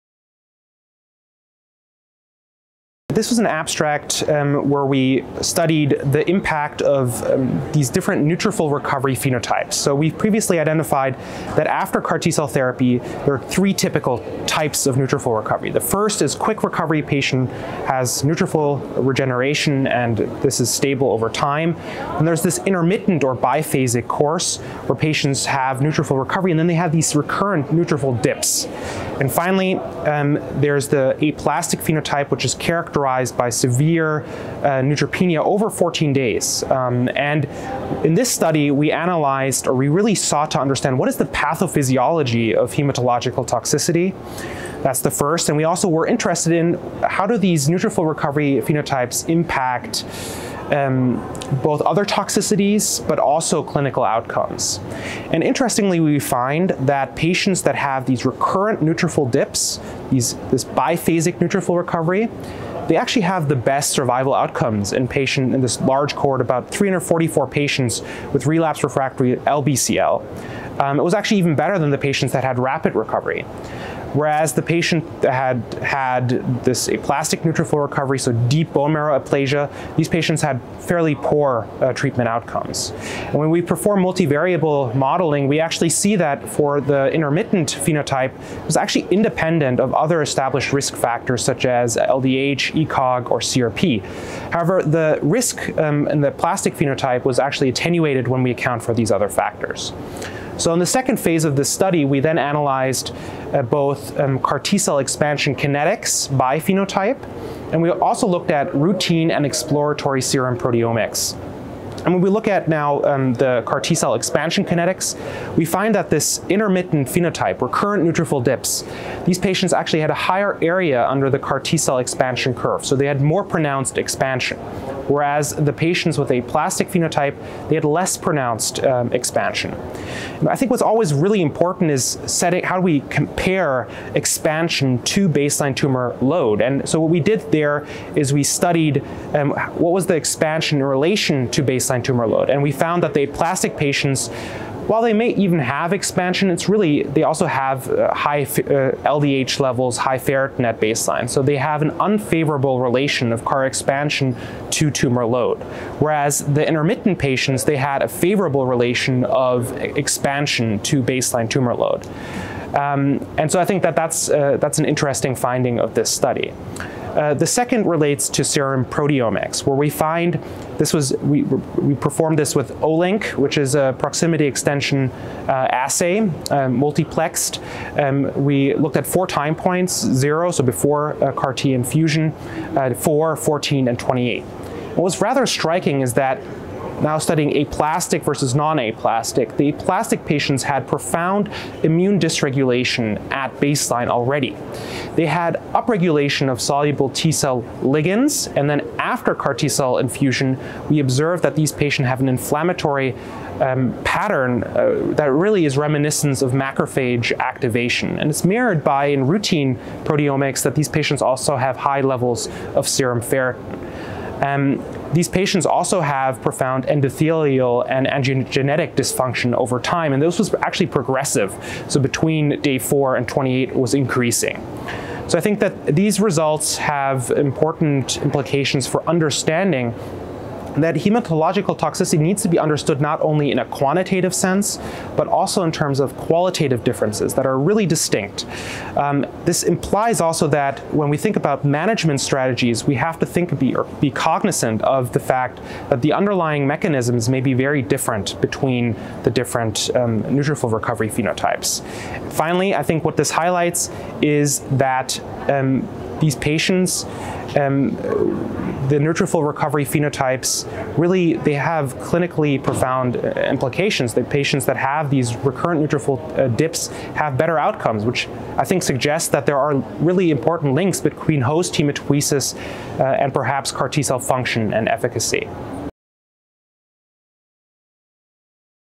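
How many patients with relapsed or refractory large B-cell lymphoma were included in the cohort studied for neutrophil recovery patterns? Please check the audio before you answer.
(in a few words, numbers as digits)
344.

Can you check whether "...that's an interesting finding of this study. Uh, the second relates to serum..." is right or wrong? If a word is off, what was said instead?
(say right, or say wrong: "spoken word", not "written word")
right.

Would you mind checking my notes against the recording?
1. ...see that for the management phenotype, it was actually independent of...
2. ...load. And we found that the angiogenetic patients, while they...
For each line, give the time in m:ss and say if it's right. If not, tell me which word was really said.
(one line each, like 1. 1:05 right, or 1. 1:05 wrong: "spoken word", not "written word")
1. 1:25 wrong: "intermittent", not "management"
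2. 2:22 wrong: "aplastic", not "angiogenetic".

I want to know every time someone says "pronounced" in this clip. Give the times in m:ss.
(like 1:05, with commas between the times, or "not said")
2:03, 2:08.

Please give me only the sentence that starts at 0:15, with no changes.
The first is quick recovery patient has neutrophil regeneration and this is stable over time.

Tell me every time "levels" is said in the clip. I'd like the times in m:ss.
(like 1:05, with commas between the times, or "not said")
2:29, 3:32.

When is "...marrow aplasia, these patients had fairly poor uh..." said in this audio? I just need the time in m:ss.
1:18.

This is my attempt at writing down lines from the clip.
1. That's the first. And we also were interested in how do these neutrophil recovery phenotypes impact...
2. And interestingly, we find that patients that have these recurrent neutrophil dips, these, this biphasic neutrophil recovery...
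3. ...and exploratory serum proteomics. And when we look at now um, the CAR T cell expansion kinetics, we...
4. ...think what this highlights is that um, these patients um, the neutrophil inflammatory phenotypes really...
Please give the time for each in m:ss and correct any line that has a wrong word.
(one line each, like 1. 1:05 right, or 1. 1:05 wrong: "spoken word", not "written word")
1. 0:44 right
2. 0:55 right
3. 1:49 right
4. 4:12 wrong: "recovery", not "inflammatory".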